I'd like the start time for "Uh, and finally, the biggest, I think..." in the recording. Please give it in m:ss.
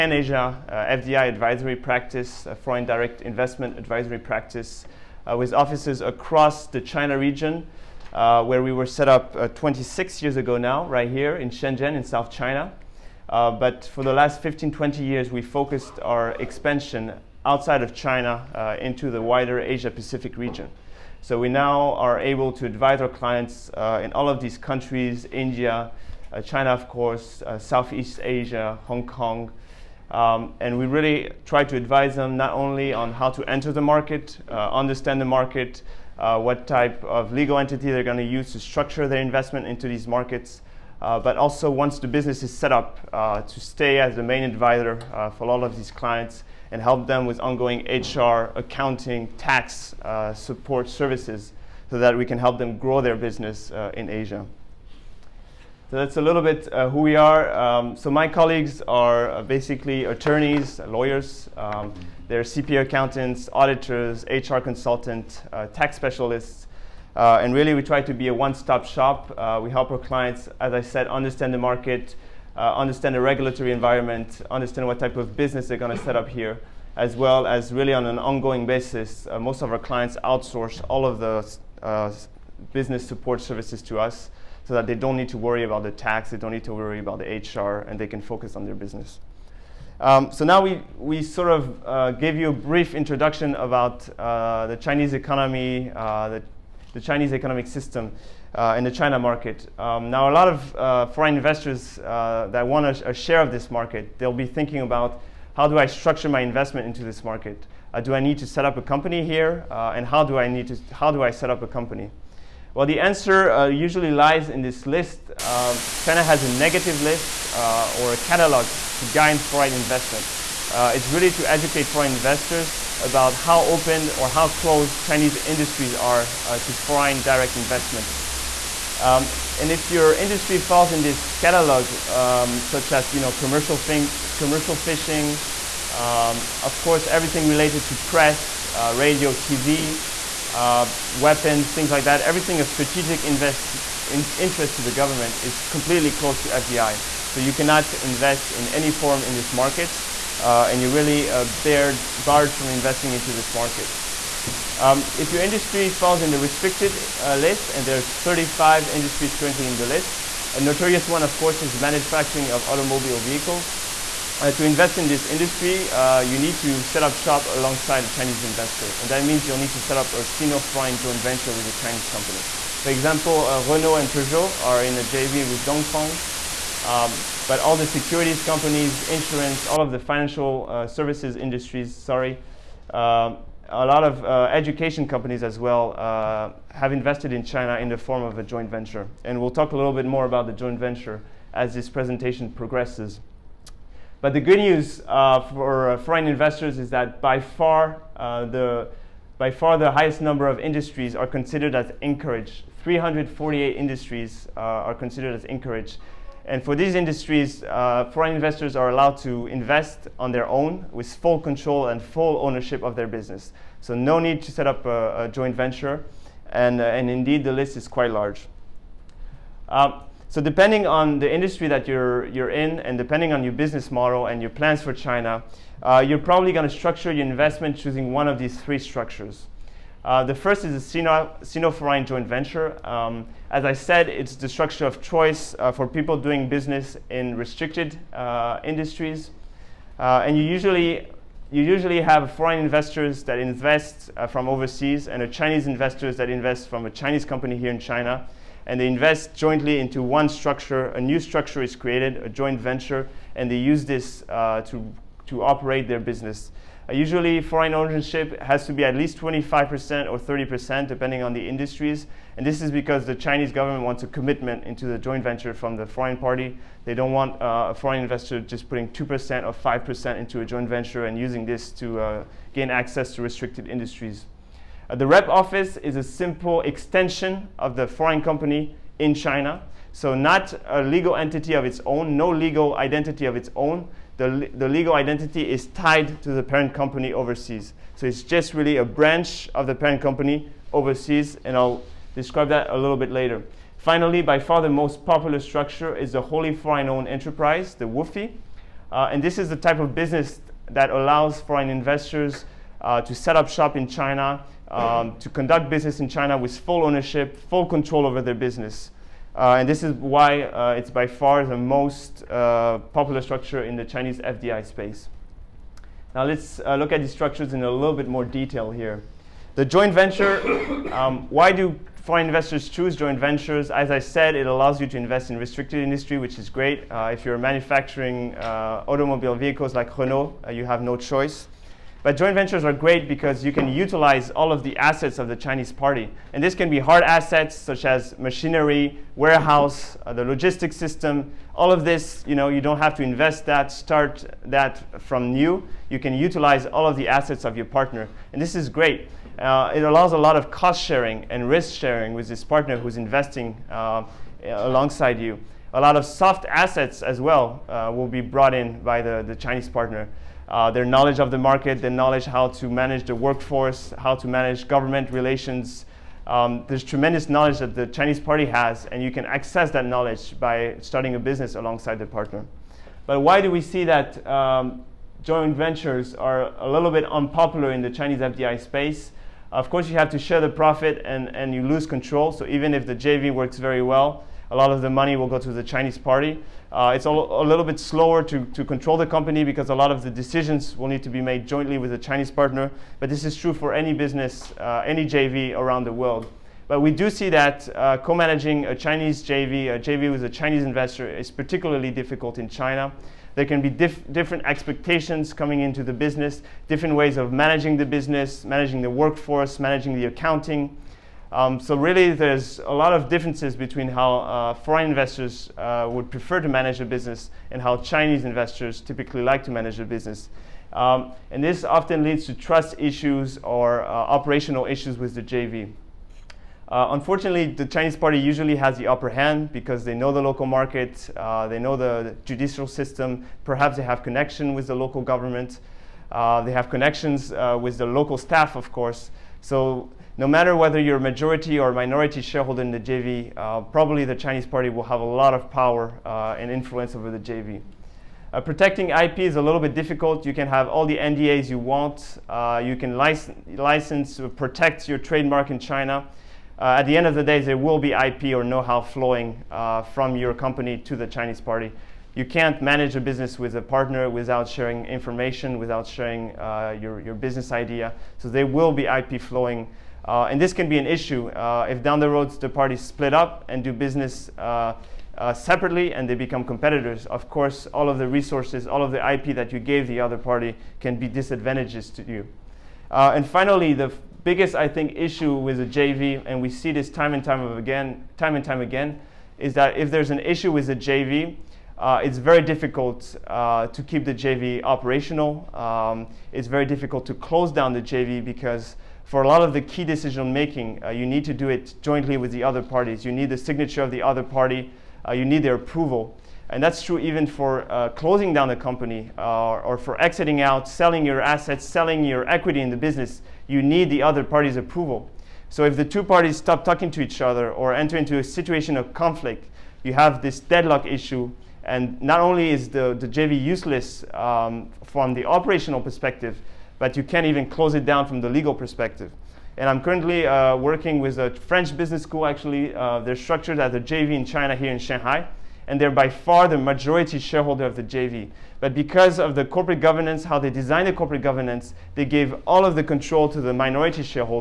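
8:02.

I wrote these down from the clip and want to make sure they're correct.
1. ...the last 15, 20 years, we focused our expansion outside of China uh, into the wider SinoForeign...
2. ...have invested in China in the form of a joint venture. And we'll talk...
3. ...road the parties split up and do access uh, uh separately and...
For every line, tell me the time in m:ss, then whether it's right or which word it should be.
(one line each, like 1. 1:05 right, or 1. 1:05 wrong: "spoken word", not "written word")
1. 0:14 wrong: "Asia", not "SinoForeign"
2. 3:06 right
3. 7:52 wrong: "business", not "access".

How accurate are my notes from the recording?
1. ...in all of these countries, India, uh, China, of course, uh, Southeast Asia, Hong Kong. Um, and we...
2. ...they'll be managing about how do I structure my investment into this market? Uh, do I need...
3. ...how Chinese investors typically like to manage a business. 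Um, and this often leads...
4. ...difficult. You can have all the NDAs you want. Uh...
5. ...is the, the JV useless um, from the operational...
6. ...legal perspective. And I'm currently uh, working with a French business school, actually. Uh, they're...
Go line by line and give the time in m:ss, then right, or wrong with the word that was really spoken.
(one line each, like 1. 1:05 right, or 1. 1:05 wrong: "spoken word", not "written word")
1. 0:24 right
2. 1:44 wrong: "thinking", not "managing"
3. 6:57 right
4. 7:29 right
5. 8:42 right
6. 8:48 right.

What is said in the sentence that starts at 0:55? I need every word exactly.
So that's a little bit who we are.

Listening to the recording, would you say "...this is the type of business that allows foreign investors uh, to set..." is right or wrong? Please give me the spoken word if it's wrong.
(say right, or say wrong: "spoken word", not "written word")
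right.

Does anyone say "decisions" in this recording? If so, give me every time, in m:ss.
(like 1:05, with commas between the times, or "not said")
6:30, 8:19.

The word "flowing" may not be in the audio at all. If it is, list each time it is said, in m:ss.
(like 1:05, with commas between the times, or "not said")
7:38, 7:49.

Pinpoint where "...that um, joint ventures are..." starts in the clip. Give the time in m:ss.
6:13.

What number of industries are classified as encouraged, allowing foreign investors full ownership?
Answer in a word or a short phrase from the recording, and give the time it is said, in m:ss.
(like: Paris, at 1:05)
348, at 3:22.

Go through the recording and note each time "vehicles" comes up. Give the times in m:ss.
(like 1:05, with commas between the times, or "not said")
2:43, 5:29.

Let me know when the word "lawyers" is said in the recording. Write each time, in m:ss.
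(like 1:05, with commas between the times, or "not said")
1:00.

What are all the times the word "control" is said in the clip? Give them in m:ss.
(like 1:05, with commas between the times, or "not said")
3:31, 5:07, 6:21, 6:28, 9:02.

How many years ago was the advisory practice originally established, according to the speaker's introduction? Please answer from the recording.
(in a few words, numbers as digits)
26.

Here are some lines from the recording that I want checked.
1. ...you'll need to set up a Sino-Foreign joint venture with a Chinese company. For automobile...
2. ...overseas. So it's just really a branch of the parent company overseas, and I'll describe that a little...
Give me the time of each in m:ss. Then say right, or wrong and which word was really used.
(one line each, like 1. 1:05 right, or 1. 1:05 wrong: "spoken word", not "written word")
1. 2:49 wrong: "example", not "automobile"
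2. 4:47 right.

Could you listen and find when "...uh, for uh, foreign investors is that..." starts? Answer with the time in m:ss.
3:15.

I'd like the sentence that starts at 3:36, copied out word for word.
And, uh, and indeed, the list is quite large.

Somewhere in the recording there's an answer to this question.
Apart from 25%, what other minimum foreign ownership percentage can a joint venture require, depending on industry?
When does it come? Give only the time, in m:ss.
4:20.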